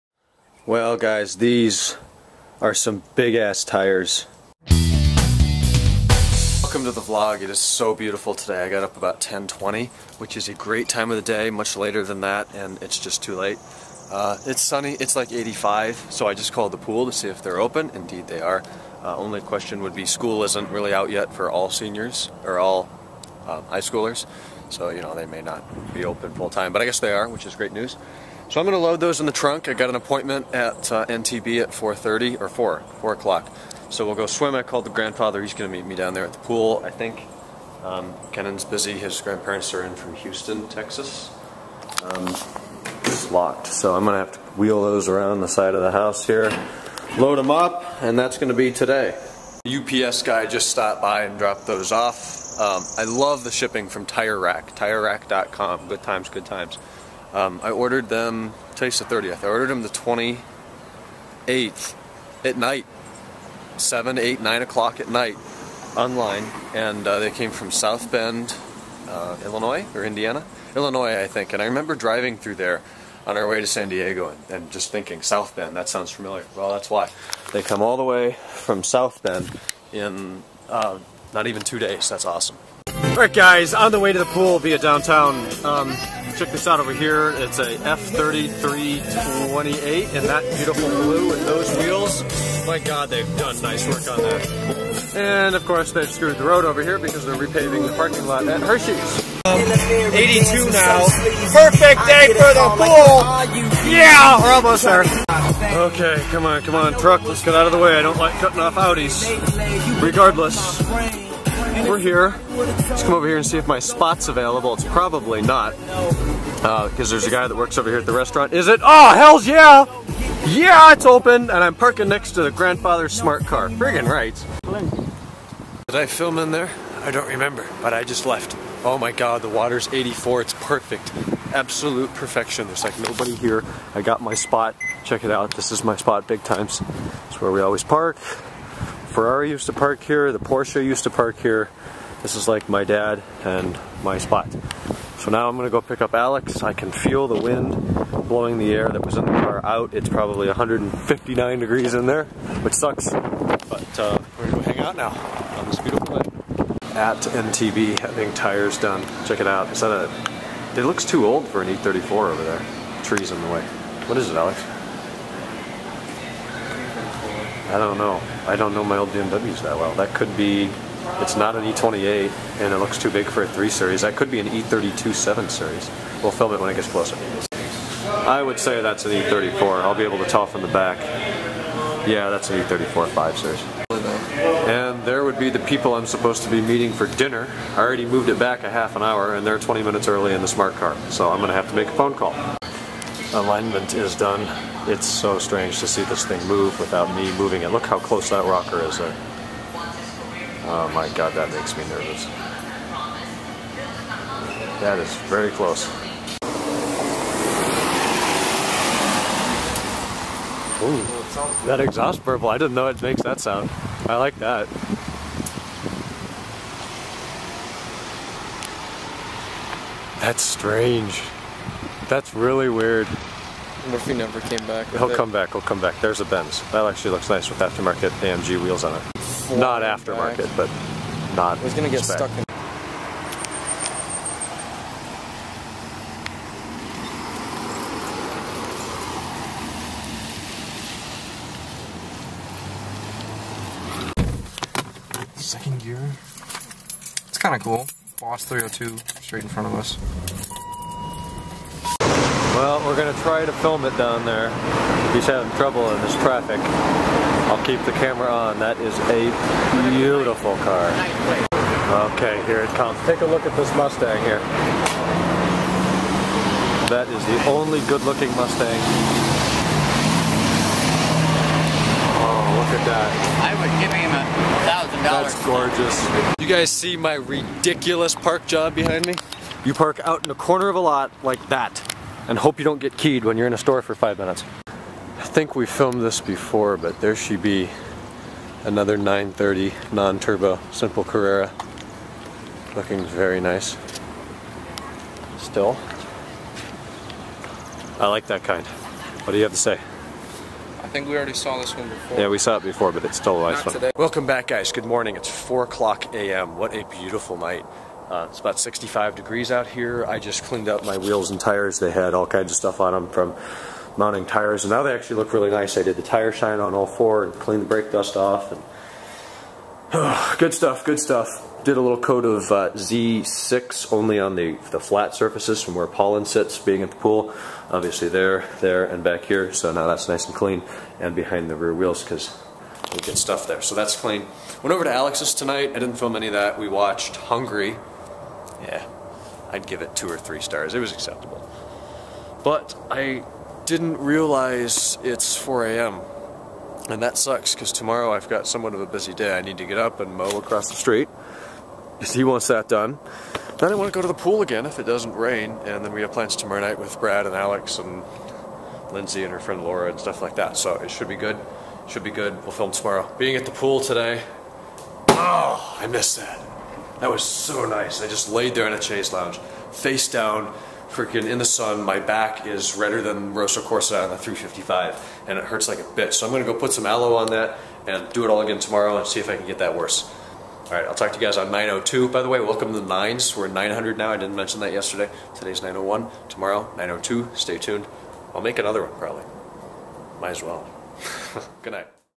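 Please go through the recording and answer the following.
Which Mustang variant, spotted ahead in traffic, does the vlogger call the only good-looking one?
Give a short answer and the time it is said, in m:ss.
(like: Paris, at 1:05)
Boss 302, at 4:08.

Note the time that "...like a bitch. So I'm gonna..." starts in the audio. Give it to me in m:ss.
6:15.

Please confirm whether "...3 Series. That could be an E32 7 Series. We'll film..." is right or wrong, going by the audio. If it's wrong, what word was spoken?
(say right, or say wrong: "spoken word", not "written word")
right.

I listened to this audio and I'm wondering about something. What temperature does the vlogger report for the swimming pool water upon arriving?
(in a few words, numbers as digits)
84.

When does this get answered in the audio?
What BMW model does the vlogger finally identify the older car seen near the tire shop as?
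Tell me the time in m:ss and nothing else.
3:02.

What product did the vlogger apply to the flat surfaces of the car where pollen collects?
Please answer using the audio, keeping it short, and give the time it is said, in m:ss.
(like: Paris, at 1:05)
Z6, at 5:22.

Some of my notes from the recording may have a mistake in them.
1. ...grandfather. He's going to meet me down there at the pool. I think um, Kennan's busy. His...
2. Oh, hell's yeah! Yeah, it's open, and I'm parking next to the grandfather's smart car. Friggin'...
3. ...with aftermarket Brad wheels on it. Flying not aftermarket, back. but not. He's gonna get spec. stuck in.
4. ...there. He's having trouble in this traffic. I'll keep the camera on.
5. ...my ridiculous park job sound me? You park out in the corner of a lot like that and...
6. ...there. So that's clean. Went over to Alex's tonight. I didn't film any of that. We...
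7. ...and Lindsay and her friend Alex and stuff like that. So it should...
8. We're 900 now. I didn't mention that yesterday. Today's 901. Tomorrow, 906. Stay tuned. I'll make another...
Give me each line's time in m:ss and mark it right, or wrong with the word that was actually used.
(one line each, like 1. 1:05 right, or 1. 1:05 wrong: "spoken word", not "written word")
1. 0:34 right
2. 1:58 right
3. 3:47 wrong: "AMG", not "Brad"
4. 4:14 right
5. 4:36 wrong: "behind", not "sound"
6. 5:33 right
7. 5:57 wrong: "Laura", not "Alex"
8. 6:23 wrong: "902", not "906".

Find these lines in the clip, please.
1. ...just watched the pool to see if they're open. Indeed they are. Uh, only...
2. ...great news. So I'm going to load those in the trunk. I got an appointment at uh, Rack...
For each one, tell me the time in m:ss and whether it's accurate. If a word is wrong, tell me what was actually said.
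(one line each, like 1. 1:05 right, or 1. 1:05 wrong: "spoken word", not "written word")
1. 0:16 wrong: "called", not "watched"
2. 0:27 wrong: "NTB", not "Rack".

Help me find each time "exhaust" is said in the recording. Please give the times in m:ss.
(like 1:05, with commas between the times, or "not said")
3:31.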